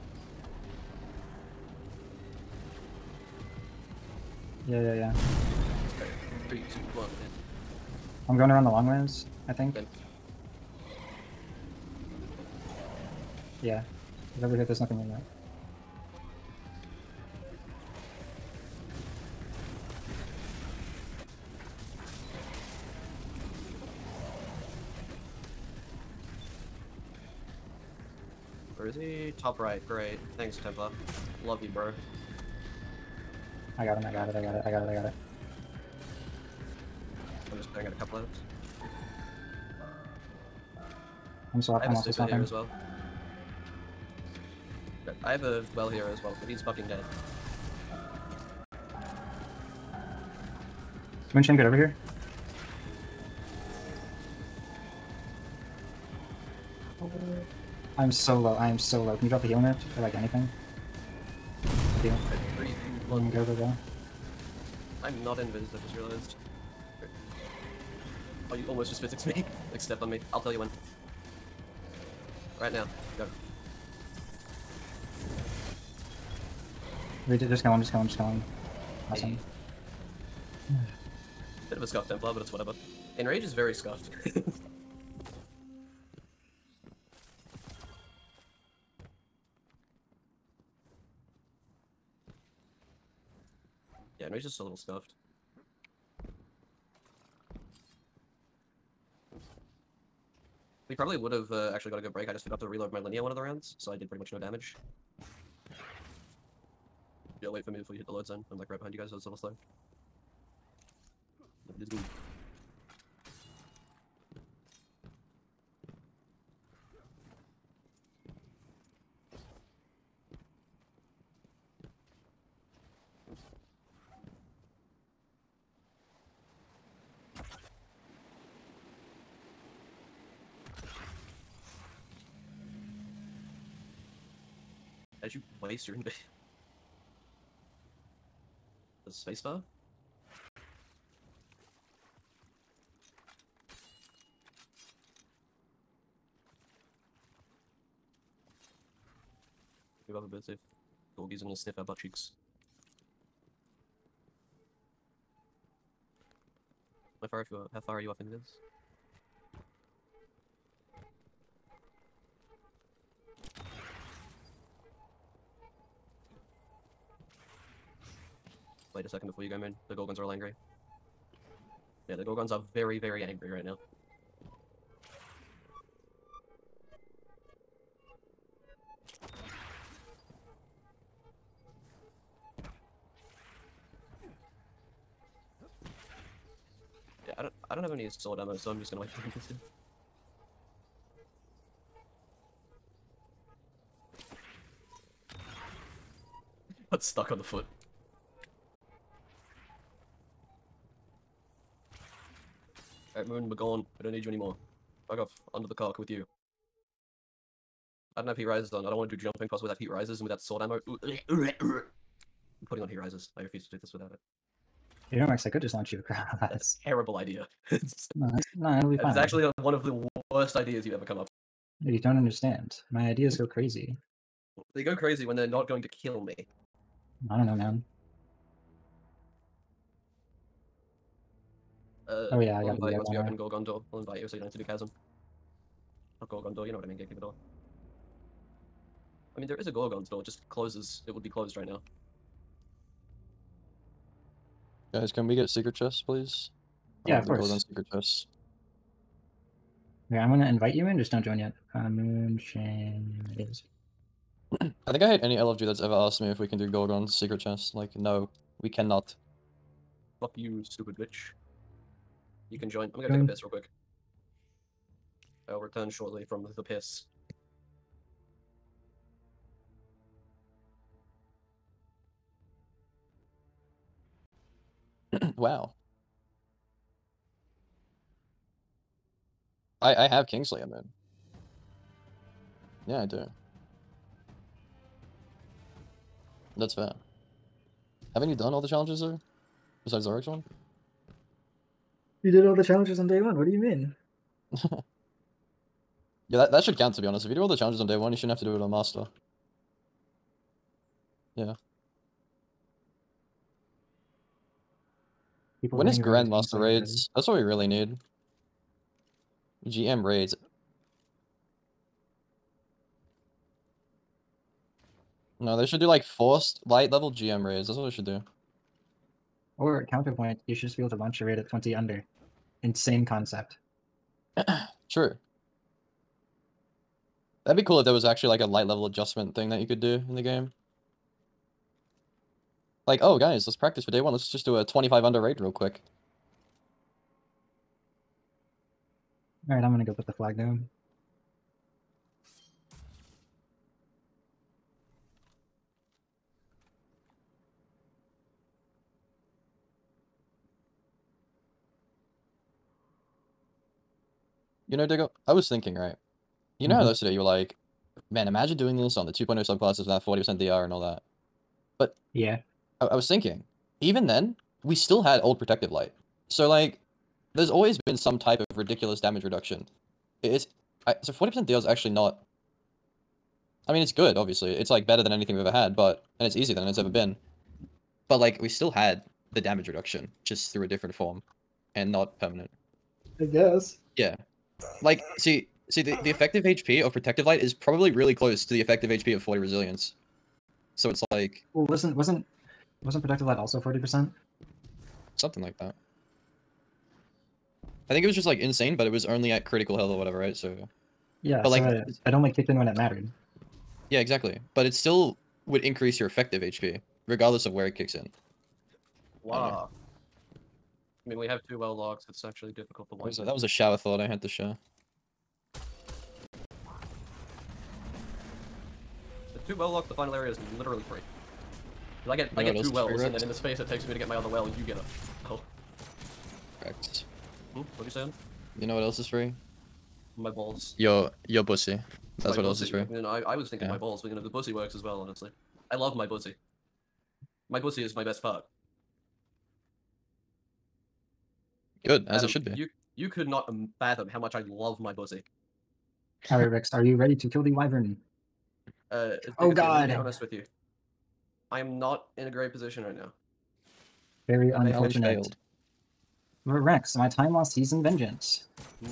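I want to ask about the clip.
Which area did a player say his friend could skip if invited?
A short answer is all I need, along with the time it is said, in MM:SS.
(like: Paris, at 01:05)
Chasm, at 03:54.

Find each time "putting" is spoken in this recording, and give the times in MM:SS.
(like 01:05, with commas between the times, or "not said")
00:37, 03:32.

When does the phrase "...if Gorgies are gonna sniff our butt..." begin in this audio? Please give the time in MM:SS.
02:30.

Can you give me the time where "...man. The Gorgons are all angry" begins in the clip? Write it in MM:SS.
02:49.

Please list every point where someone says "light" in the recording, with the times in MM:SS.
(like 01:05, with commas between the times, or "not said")
05:16, 05:28, 06:05, 06:27, 06:33.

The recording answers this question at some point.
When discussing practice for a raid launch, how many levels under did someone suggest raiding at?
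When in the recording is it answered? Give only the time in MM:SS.
05:34.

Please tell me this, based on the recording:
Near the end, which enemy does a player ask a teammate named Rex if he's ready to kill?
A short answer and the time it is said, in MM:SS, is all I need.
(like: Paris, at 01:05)
the wyvern, at 07:27.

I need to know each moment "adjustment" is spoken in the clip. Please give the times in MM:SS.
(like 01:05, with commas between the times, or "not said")
05:28.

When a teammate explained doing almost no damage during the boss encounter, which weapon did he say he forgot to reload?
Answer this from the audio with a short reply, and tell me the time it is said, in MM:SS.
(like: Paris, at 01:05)
linear, at 01:42.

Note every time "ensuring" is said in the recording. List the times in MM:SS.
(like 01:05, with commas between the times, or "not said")
not said.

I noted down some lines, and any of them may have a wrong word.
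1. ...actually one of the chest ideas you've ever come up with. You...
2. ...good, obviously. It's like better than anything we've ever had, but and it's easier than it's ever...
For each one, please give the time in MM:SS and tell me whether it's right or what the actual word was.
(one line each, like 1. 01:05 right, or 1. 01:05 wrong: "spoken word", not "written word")
1. 03:39 wrong: "worst", not "chest"
2. 06:13 right.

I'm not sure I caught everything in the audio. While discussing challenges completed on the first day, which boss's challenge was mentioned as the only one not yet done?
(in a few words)
Oryx.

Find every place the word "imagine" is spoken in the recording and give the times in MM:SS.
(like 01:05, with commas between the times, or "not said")
05:58.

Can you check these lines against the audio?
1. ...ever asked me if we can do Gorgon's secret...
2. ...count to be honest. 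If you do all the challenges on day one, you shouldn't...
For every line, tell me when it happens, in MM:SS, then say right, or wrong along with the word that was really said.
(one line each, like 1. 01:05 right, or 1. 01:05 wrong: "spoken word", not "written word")
1. 04:15 right
2. 04:56 right.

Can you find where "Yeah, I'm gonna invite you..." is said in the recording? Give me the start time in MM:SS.
04:10.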